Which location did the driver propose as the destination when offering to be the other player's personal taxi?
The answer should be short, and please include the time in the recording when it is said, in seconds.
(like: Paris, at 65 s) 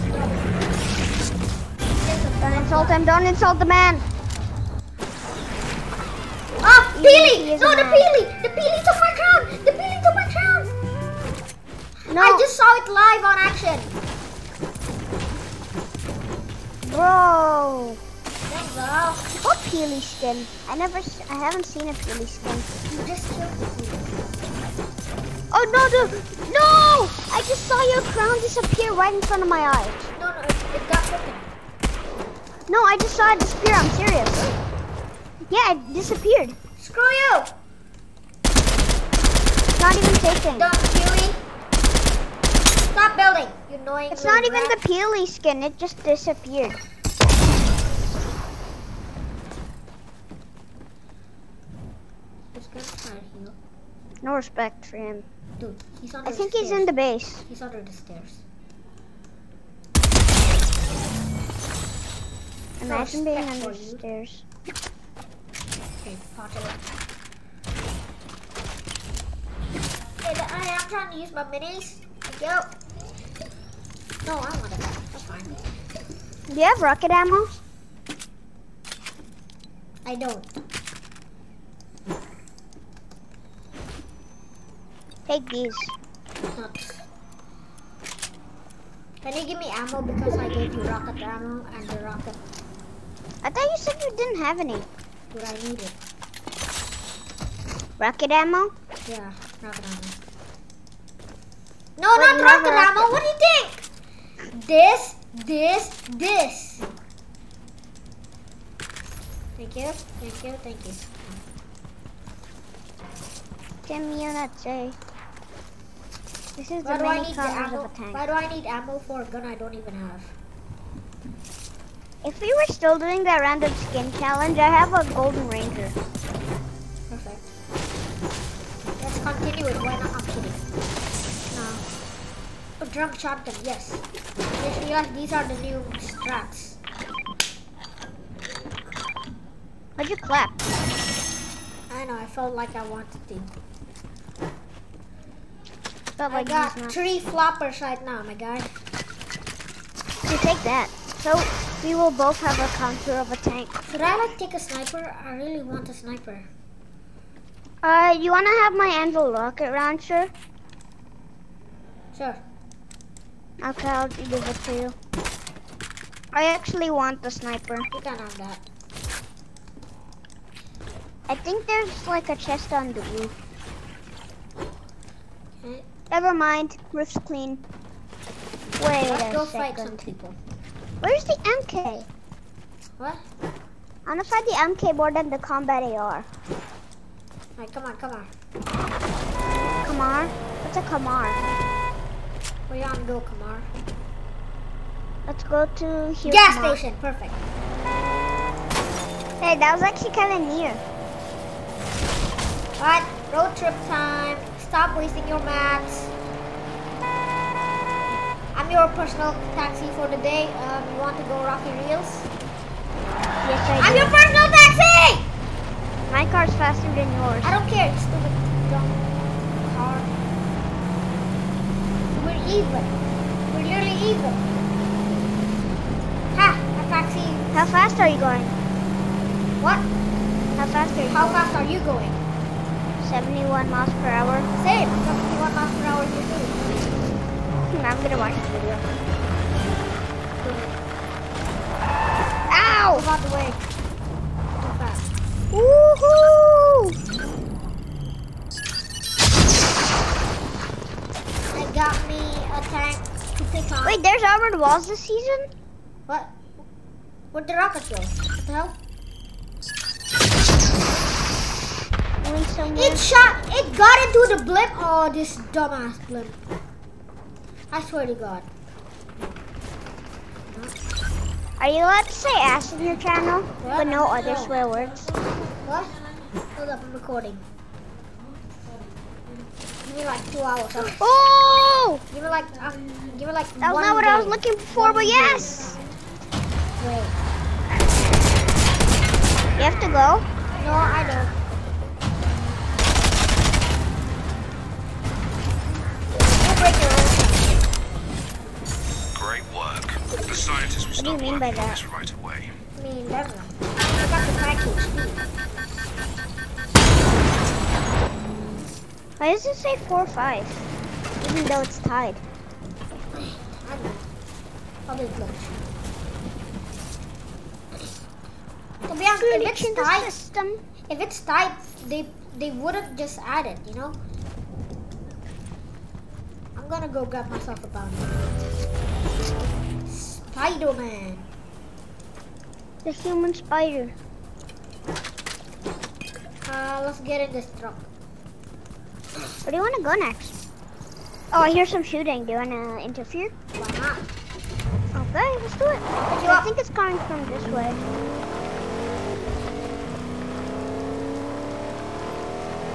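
Rocky Reels, at 211 s.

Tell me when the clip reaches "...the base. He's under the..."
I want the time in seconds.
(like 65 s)
56 s.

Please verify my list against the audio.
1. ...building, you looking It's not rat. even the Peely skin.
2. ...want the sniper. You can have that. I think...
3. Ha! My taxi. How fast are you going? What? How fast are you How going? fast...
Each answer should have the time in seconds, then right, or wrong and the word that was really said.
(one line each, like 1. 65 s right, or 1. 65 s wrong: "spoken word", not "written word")
1. 43 s wrong: "annoying", not "looking"
2. 166 s right
3. 226 s right.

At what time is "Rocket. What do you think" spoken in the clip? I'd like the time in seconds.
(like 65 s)
103 s.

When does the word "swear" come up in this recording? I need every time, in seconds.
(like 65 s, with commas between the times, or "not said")
267 s, 274 s.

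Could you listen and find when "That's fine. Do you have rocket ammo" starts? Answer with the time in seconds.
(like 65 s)
74 s.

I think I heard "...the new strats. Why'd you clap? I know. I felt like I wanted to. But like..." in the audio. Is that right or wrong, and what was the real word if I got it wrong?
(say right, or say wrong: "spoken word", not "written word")
right.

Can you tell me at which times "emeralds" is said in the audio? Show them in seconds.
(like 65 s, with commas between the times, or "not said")
not said.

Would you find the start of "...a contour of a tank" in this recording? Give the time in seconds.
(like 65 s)
152 s.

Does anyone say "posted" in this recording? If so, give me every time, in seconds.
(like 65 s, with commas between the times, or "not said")
not said.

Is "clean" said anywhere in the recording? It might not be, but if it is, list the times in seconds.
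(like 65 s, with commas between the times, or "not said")
177 s.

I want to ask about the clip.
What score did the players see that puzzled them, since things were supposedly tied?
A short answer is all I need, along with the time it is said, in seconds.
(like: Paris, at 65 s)
4-5, at 309 s.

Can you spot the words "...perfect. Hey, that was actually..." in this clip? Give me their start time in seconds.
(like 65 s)
197 s.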